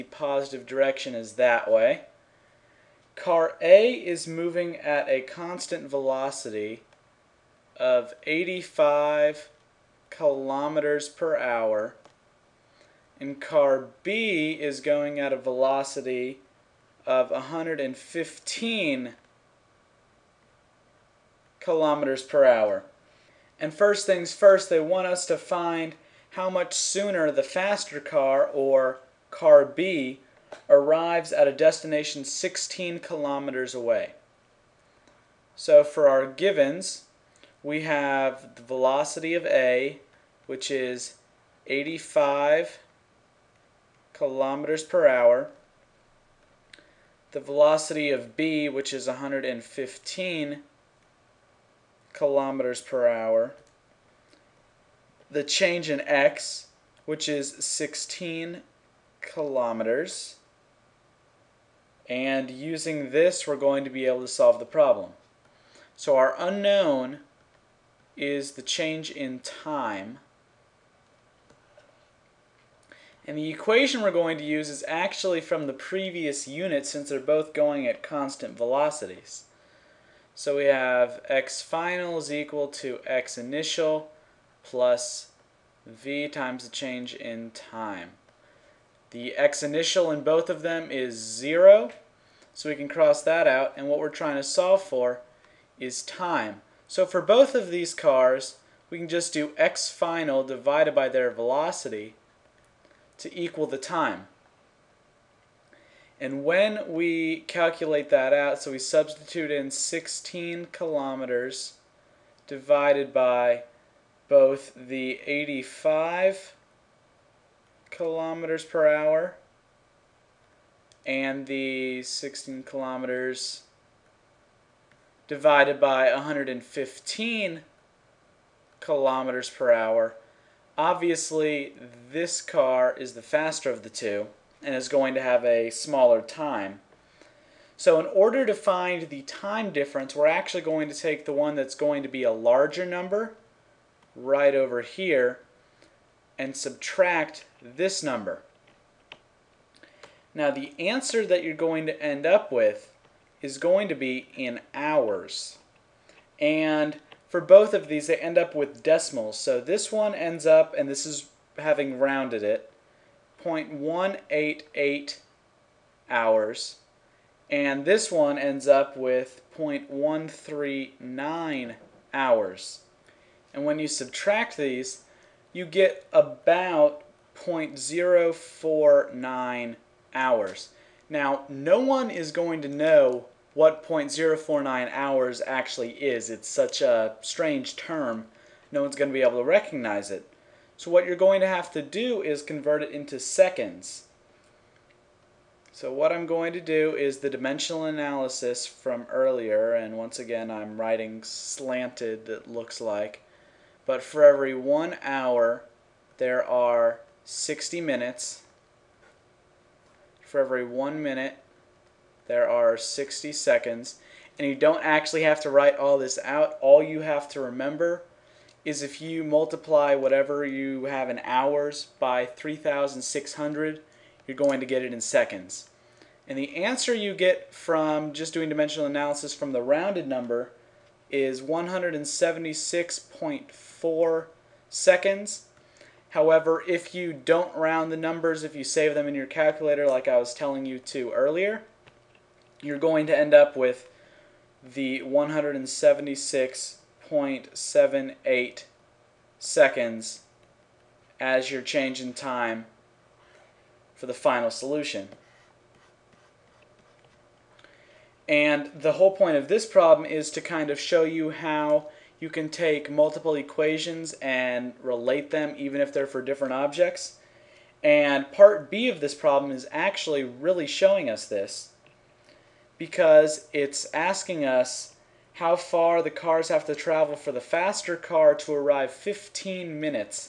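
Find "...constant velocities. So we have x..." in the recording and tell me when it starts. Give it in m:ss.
1:18.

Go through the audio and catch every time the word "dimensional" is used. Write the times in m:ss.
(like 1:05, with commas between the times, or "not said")
3:17, 3:48.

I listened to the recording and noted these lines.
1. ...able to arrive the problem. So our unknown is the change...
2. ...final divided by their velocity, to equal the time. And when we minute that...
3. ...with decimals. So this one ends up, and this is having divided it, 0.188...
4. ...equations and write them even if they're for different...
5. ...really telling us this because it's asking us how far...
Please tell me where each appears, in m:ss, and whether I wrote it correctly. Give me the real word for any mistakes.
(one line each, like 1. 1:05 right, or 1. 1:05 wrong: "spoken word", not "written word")
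1. 1:04 wrong: "solve", not "arrive"
2. 1:39 wrong: "calculate", not "minute"
3. 2:38 wrong: "rounded", not "divided"
4. 4:23 wrong: "relate", not "write"
5. 4:30 wrong: "showing", not "telling".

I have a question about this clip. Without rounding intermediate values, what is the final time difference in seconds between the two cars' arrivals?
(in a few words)
176.78 seconds.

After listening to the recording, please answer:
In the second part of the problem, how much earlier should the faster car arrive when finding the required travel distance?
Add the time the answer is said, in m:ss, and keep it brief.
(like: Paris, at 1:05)
15 minutes, at 4:38.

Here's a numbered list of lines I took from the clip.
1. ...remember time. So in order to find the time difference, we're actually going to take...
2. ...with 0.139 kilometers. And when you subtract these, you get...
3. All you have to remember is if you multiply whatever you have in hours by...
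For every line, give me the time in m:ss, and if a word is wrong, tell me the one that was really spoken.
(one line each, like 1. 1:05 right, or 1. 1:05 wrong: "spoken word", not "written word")
1. 2:15 wrong: "smaller", not "remember"
2. 2:48 wrong: "hours", not "kilometers"
3. 3:36 right.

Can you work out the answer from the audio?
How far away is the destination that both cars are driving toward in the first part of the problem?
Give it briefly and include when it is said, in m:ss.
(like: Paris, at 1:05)
16 km, at 0:32.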